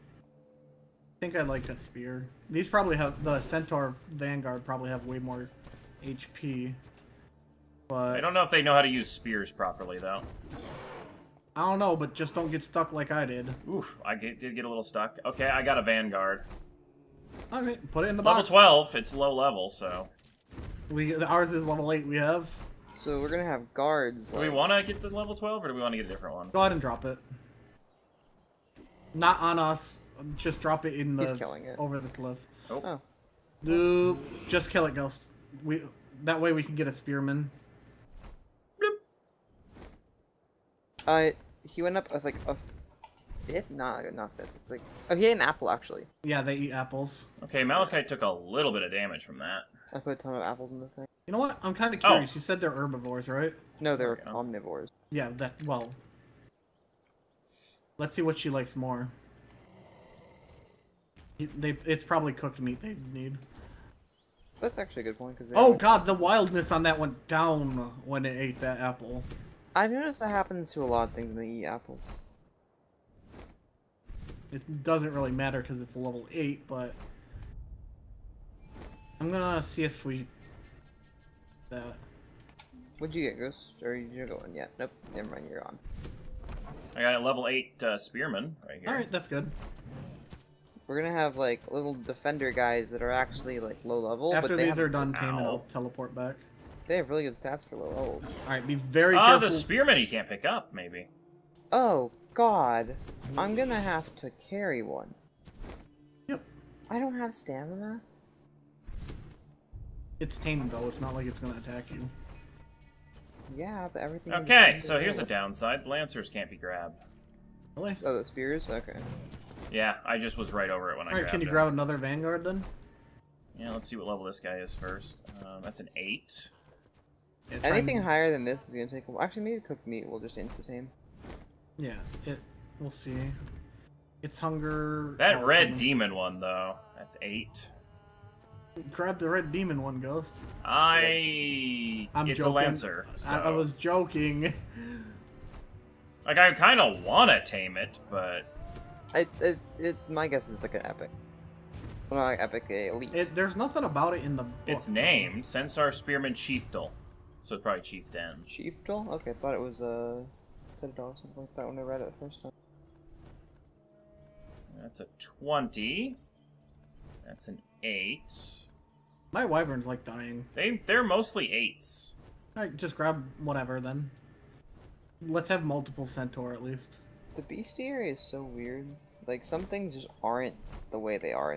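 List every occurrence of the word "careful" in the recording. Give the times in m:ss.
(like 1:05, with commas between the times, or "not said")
1:39.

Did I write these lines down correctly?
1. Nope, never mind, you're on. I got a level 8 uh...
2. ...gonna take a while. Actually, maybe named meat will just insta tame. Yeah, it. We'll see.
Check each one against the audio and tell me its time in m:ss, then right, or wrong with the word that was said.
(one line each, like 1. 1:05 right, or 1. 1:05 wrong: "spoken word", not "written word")
1. 1:24 right
2. 2:08 wrong: "cooked", not "named".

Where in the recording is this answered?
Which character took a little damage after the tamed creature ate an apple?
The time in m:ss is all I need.
0:47.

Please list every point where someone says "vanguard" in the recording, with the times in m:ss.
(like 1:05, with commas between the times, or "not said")
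0:04, 0:15, 2:01.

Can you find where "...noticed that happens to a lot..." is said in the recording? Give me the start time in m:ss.
1:09.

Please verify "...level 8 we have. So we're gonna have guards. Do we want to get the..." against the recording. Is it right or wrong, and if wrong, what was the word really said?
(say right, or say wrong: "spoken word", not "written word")
right.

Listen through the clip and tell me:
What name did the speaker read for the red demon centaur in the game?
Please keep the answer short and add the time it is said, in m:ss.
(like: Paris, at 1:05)
Sensar Spearman Chiefdal, at 2:35.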